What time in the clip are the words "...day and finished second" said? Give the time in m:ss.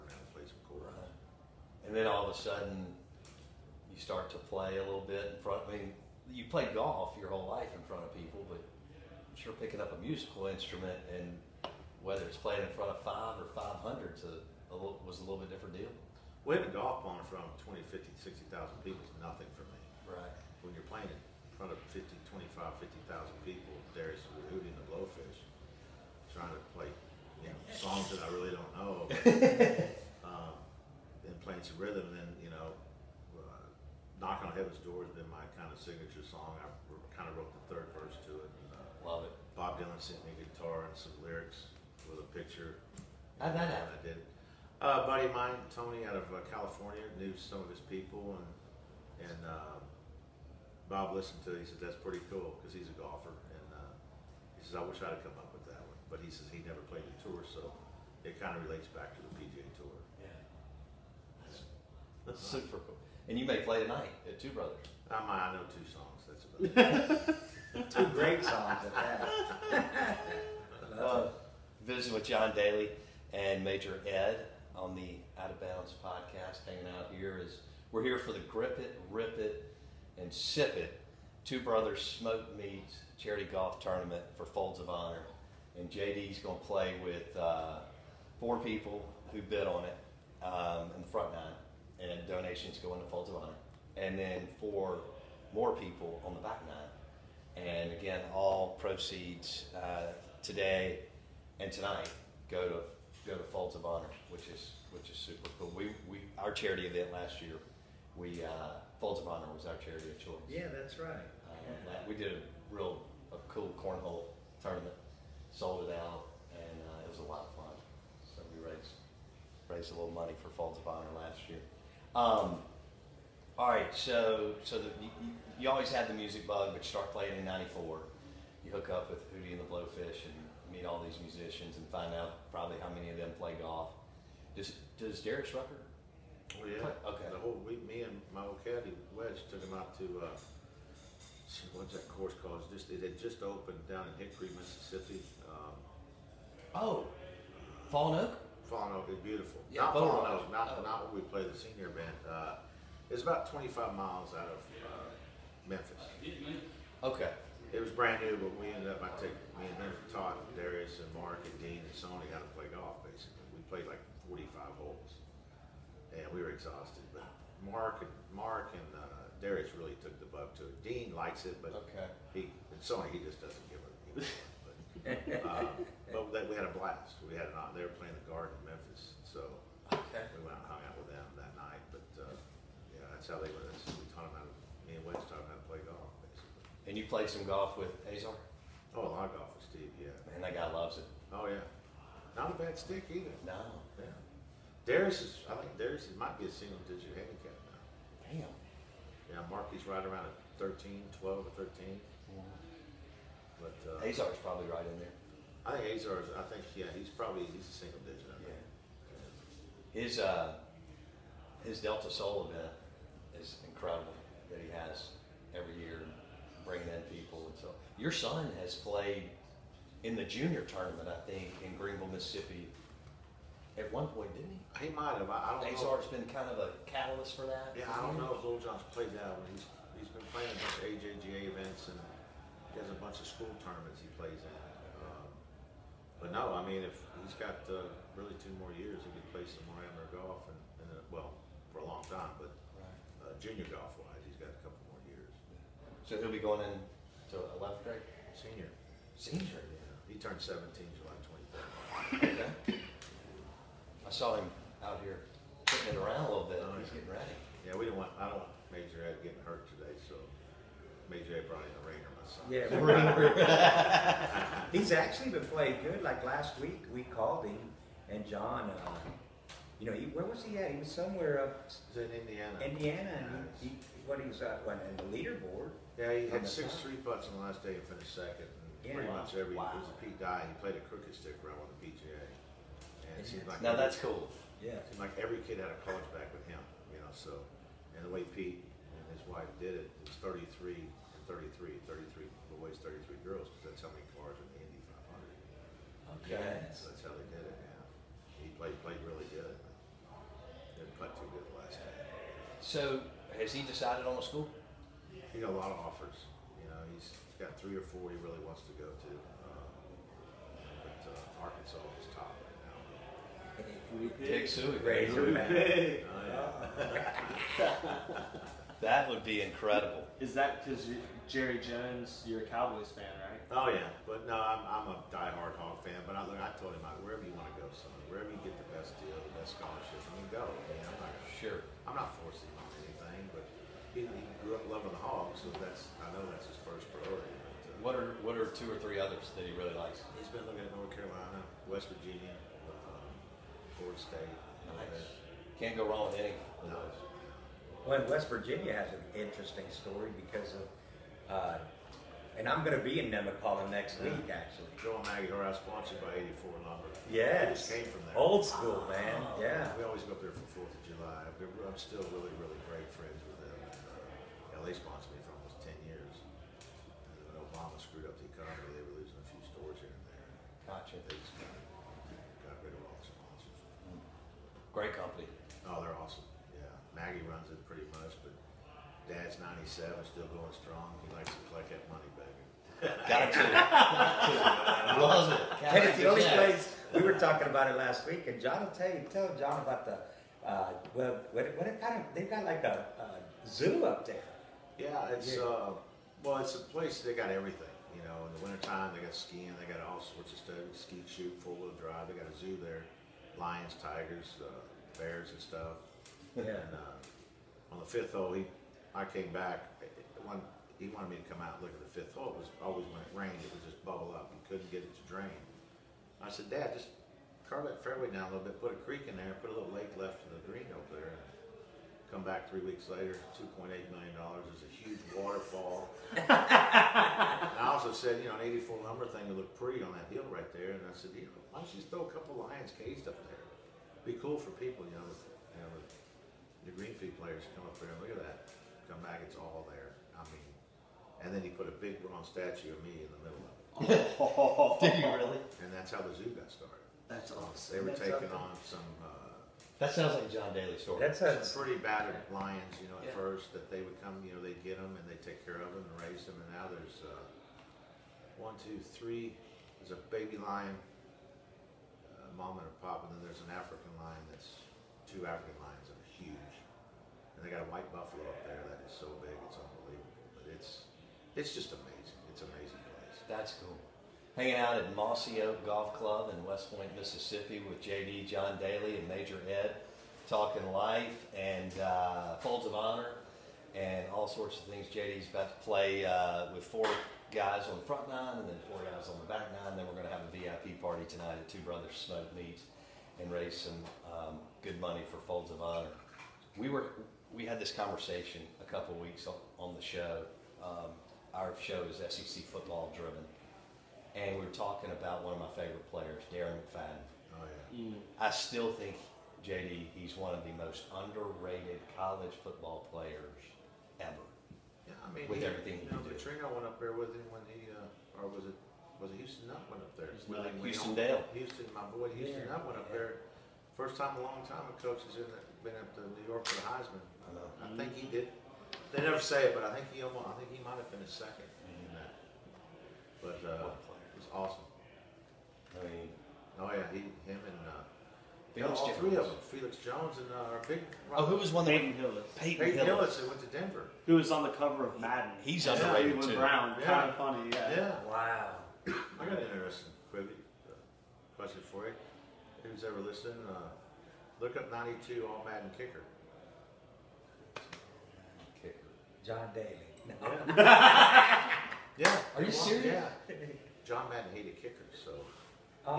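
4:37.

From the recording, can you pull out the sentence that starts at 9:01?
Oh, who was one that Peyton Hillis?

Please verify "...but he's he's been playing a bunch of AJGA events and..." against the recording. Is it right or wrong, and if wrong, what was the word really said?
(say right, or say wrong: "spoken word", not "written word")
right.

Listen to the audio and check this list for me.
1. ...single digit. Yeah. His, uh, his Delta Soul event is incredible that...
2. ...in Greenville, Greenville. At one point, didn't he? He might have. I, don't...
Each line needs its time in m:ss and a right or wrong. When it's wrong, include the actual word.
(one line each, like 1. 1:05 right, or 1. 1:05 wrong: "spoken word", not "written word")
1. 3:27 right
2. 3:41 wrong: "Mississippi", not "Greenville".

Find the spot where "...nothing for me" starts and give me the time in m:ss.
0:19.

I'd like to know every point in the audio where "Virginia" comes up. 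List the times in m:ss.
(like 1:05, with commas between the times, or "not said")
5:41, 5:48.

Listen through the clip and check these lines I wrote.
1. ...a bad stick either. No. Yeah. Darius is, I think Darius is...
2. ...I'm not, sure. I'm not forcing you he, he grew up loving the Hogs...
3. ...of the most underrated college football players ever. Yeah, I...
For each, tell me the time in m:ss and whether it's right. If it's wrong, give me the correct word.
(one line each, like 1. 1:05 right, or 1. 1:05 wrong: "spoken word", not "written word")
1. 3:12 right
2. 5:30 right
3. 8:30 right.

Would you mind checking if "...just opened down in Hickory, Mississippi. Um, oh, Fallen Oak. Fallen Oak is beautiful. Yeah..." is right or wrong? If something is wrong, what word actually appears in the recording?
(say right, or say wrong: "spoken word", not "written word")
right.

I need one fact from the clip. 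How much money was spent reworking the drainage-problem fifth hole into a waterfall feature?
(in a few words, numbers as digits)
$2.8 million.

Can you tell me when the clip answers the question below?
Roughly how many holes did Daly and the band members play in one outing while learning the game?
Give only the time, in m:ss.
2:44.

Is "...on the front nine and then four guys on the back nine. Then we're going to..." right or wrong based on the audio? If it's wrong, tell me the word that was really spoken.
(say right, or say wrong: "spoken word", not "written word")
right.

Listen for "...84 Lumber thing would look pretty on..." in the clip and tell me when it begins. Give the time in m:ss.
7:08.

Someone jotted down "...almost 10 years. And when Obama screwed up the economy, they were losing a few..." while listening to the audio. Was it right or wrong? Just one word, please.
right.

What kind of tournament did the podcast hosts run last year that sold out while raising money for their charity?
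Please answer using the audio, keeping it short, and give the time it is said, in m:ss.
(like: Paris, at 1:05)
Cornhole tournament, at 1:53.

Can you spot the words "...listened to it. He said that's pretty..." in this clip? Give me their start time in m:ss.
0:51.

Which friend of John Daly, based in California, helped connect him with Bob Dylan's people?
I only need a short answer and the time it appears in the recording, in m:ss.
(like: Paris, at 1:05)
Tony, at 0:45.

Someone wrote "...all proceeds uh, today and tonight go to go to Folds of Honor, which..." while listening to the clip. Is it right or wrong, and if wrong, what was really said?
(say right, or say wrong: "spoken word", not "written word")
right.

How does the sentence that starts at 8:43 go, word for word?
First time a long time a coach has been up to New York for the Heisman.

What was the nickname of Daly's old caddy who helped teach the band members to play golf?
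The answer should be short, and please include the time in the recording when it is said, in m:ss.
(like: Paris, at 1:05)
Wedge, at 2:19.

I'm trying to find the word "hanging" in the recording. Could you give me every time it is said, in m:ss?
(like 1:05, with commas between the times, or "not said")
1:16, 7:54.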